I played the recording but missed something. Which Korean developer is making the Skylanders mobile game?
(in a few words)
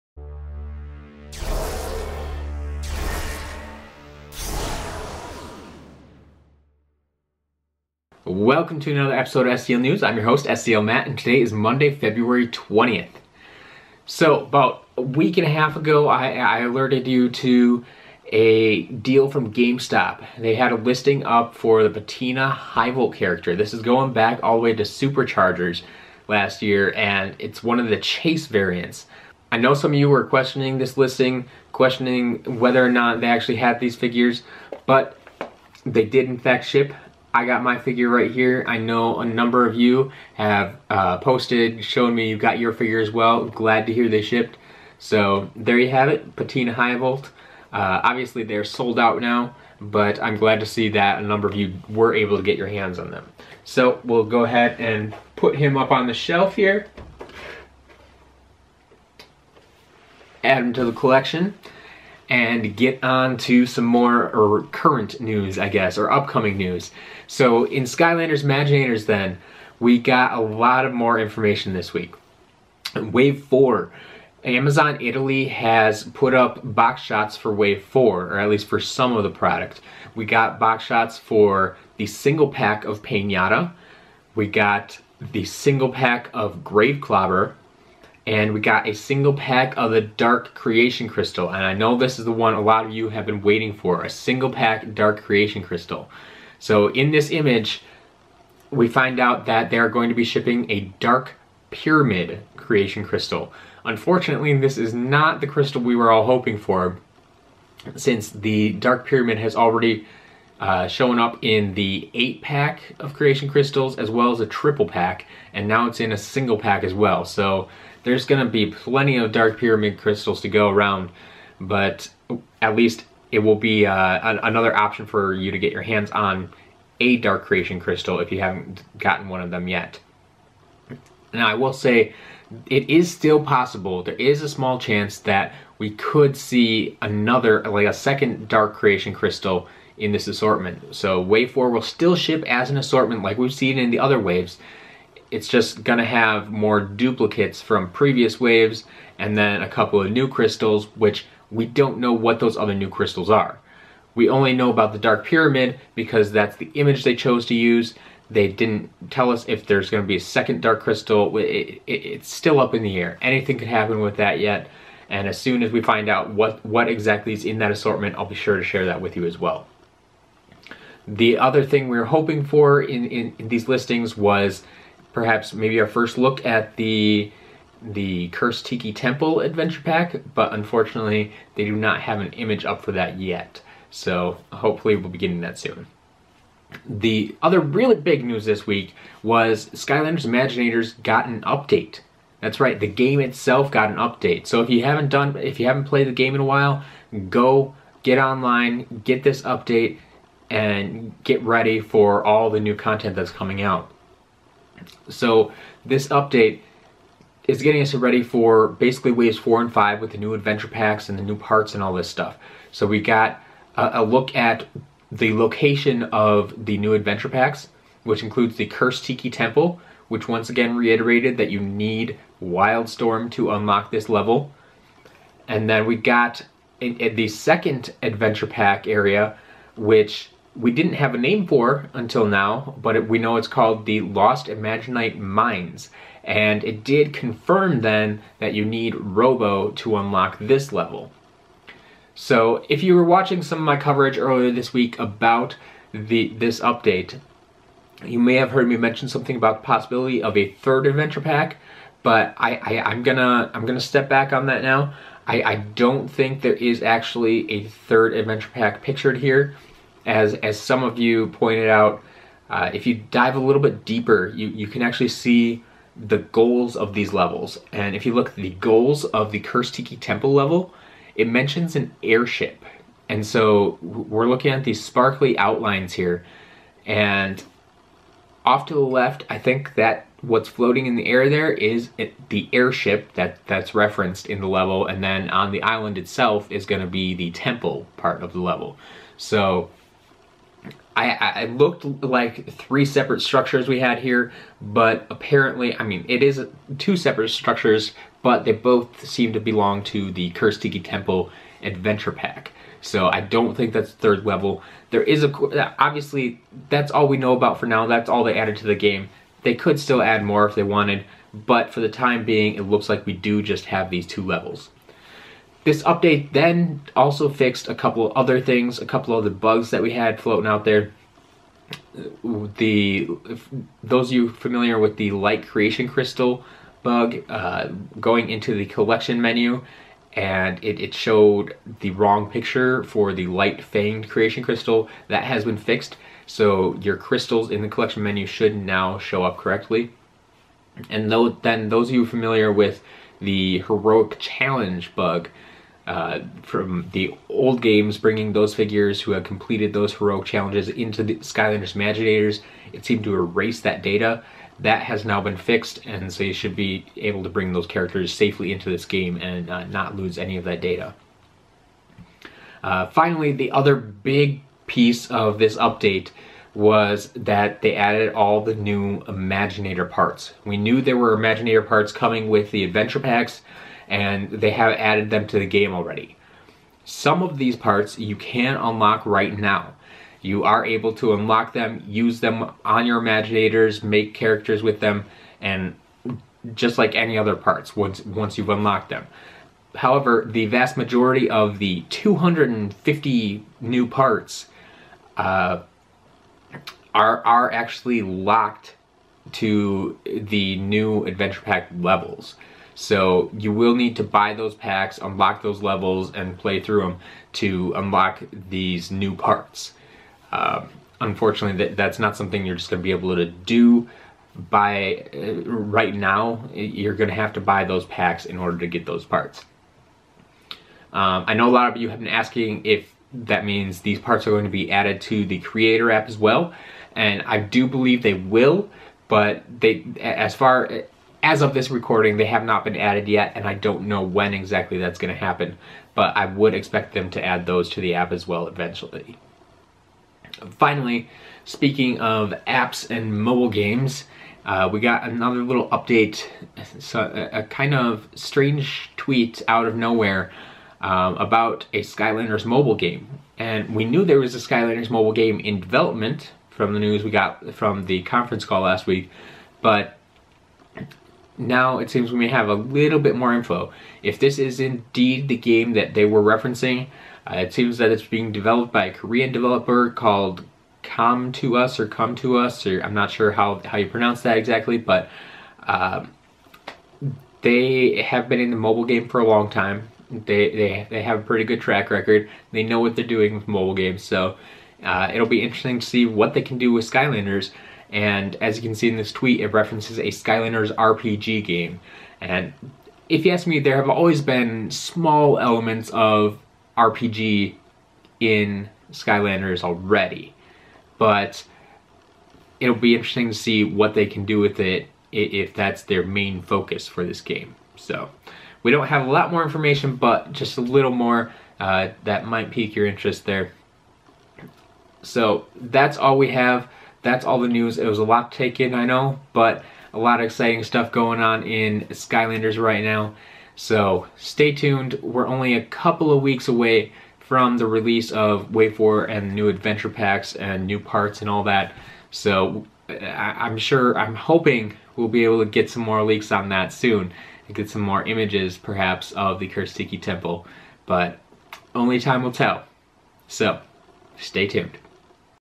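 Com2Us.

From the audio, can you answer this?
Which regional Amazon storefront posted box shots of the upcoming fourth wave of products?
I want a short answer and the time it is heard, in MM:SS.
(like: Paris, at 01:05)
Amazon Italy, at 01:14.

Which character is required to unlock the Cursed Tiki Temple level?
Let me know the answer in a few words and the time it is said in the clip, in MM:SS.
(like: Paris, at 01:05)
Wild Storm, at 03:42.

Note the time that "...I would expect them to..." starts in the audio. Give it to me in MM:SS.
07:16.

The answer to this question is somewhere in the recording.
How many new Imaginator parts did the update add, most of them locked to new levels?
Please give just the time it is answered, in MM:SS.
06:31.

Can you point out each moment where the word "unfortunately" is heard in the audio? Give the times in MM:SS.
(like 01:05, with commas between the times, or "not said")
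01:43, 03:00, 06:50.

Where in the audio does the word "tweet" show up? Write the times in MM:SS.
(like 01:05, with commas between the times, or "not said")
07:28, 08:09.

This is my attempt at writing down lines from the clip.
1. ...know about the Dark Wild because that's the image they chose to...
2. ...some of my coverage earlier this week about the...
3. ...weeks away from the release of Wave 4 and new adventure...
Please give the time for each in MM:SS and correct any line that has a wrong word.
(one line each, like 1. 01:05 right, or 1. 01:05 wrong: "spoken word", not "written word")
1. 02:34 wrong: "Pyramid", not "Wild"
2. 04:03 right
3. 08:46 right.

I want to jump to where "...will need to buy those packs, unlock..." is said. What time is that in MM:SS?
06:43.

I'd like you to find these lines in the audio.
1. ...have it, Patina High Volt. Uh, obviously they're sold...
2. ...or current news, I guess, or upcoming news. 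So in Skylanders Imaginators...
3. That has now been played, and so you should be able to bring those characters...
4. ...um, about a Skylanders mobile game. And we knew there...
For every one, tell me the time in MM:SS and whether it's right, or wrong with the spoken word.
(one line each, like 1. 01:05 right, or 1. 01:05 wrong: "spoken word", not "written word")
1. 00:45 right
2. 01:04 right
3. 05:54 wrong: "fixed", not "played"
4. 07:30 right.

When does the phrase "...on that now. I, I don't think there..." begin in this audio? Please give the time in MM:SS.
04:14.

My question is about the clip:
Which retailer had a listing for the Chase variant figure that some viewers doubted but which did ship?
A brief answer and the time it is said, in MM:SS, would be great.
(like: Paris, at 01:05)
GameStop, at 00:19.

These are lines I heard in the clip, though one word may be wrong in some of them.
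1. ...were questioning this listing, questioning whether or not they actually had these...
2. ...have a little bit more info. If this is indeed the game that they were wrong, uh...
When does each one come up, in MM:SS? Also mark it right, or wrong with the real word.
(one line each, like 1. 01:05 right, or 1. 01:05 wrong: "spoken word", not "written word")
1. 00:30 right
2. 07:42 wrong: "referencing", not "wrong".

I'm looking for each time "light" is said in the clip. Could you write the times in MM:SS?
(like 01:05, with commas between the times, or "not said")
05:25, 05:33.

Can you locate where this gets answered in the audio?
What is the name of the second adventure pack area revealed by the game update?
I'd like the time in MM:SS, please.
03:54.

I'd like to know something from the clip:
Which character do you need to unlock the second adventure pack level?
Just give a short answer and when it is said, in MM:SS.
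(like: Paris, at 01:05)
Ro-Bow, at 03:58.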